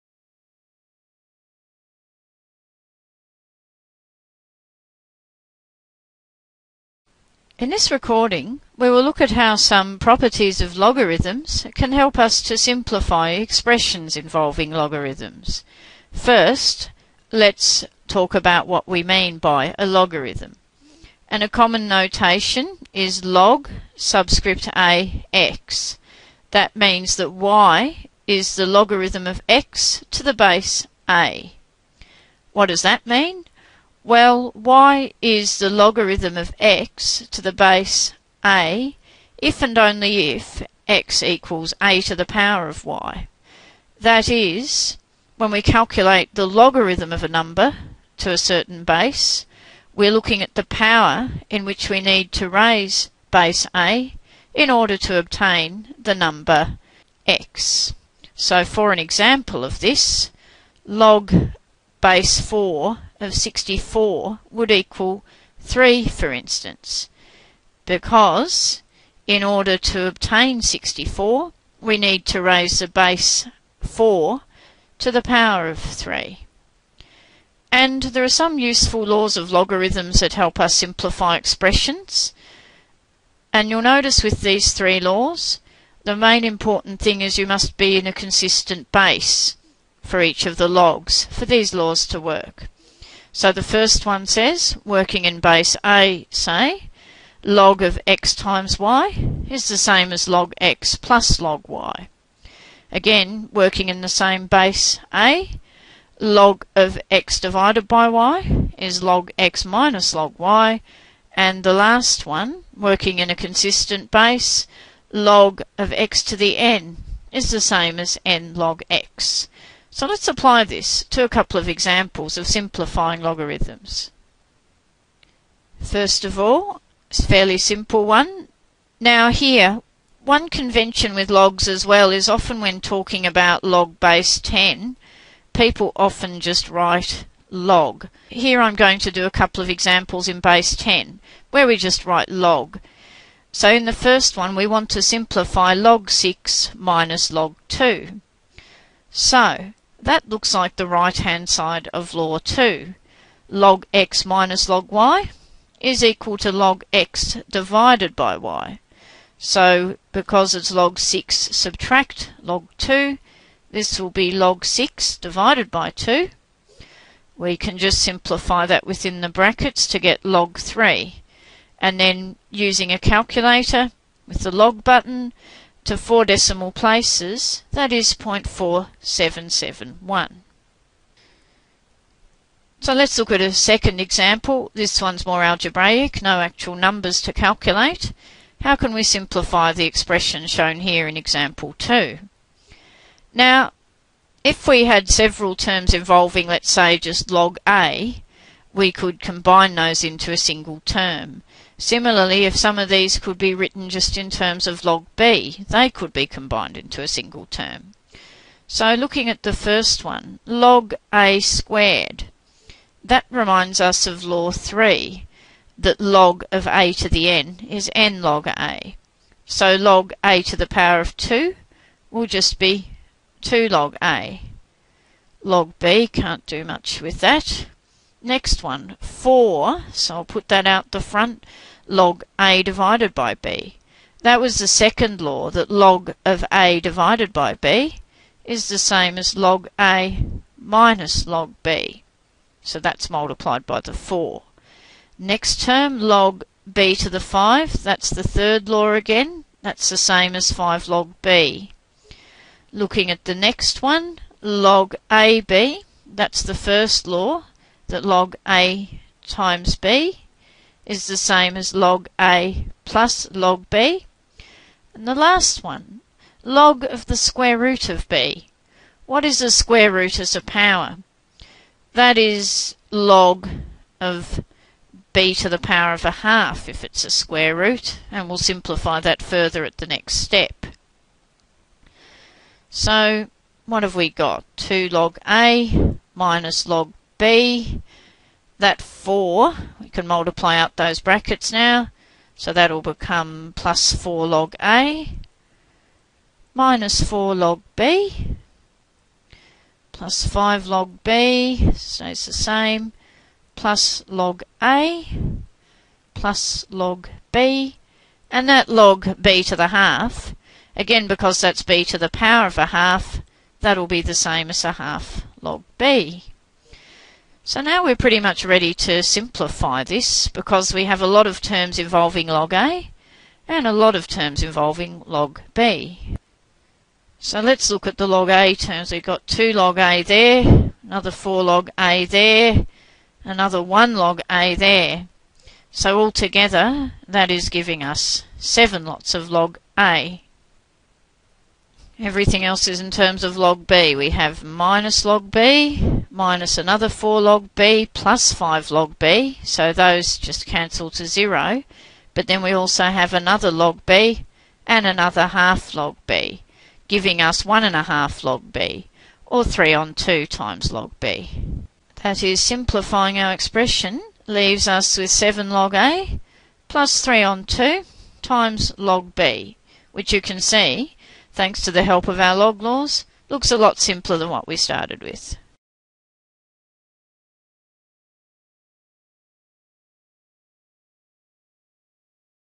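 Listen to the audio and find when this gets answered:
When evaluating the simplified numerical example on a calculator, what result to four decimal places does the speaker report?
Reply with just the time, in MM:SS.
02:58.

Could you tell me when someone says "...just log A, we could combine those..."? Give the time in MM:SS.
03:16.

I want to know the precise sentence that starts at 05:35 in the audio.
So altogether that is giving us 7 lots of log A.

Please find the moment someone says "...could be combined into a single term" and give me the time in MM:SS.
03:25.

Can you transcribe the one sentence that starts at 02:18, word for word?
Here I'm going to do a couple of examples in base 10 where we just write log.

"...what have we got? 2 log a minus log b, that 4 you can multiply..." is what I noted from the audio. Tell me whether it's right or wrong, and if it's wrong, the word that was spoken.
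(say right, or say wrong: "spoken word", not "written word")
right.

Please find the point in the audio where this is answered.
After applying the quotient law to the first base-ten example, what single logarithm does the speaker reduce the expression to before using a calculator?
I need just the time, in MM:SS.
02:50.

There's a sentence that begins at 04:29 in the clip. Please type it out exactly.
What is the square root as a power?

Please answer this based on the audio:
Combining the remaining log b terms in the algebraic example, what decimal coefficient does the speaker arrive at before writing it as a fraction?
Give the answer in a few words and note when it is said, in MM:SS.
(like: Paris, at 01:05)
1.5, at 05:57.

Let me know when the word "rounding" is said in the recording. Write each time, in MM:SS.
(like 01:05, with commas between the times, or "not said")
not said.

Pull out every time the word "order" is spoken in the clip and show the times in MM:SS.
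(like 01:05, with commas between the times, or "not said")
00:54, 01:09.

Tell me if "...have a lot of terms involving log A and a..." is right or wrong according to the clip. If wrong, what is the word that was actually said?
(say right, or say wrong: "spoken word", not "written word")
right.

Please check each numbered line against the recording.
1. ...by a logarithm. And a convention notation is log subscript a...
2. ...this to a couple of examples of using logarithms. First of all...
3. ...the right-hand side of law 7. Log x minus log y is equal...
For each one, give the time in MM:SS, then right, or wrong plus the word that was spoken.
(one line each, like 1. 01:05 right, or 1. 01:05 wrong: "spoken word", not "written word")
1. 00:19 wrong: "common", not "convention"
2. 02:00 wrong: "simplifying", not "using"
3. 02:30 wrong: "2", not "7".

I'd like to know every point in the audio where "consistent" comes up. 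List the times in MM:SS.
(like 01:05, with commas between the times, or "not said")
01:28, 01:53.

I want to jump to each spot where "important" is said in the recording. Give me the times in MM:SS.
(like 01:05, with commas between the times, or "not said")
01:26.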